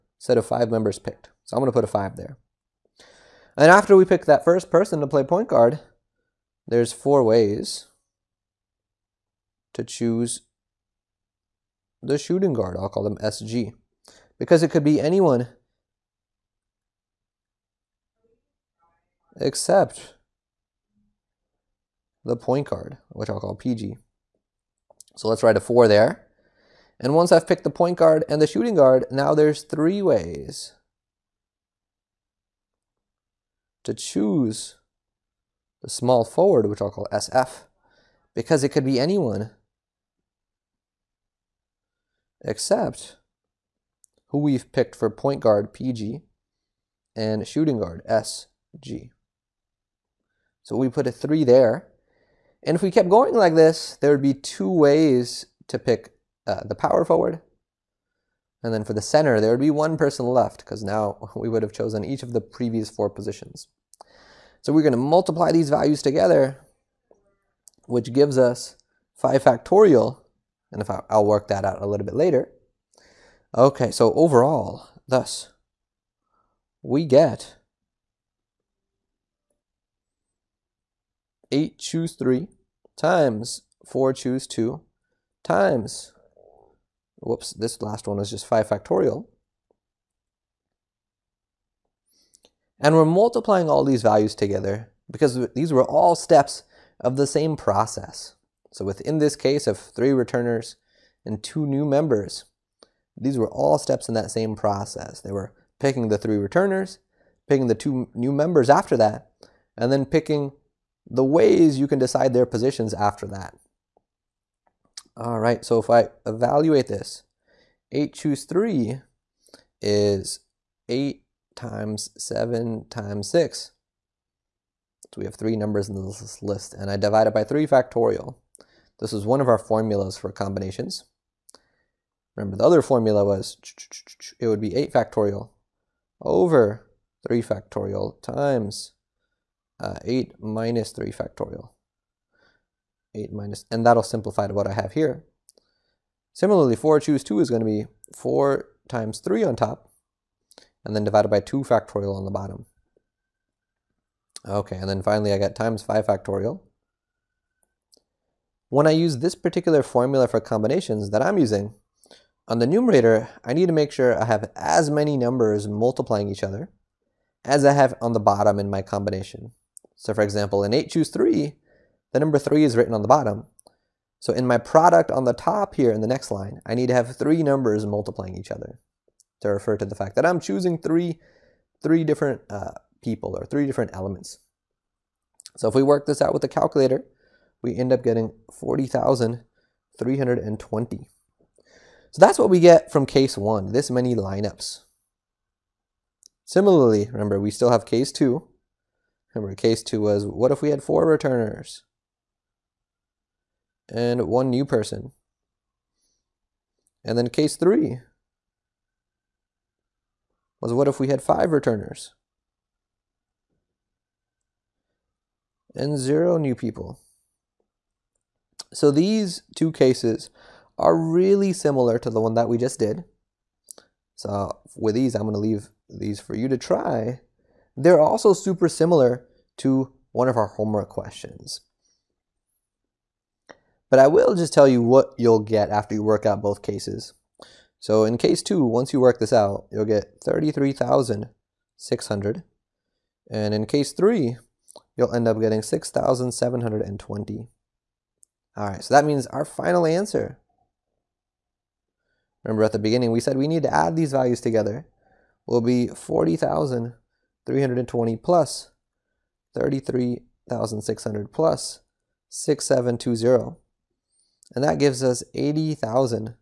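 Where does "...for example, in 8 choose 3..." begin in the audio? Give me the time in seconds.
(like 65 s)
170 s.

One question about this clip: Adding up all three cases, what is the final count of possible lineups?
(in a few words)
80,640.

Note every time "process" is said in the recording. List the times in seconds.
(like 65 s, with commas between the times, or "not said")
97 s, 104 s.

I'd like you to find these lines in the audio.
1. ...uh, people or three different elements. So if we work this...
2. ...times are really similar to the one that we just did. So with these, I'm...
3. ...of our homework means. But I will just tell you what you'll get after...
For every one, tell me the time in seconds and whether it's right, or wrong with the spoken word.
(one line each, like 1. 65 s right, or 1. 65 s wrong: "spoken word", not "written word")
1. 182 s right
2. 219 s wrong: "cases", not "times"
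3. 230 s wrong: "questions", not "means".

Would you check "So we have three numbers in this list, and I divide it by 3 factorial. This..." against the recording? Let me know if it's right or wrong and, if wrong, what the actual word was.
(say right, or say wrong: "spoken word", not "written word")
right.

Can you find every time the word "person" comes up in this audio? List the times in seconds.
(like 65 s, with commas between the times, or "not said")
4 s, 59 s, 204 s.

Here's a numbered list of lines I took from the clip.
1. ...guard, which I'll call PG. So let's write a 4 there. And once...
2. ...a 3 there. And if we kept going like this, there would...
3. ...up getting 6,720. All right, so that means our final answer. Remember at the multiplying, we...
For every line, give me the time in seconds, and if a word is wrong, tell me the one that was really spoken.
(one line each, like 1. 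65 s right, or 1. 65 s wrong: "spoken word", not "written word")
1. 22 s right
2. 51 s right
3. 245 s wrong: "beginning", not "multiplying".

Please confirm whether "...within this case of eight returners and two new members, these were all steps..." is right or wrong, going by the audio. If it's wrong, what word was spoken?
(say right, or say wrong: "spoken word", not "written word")
wrong: "three", not "eight".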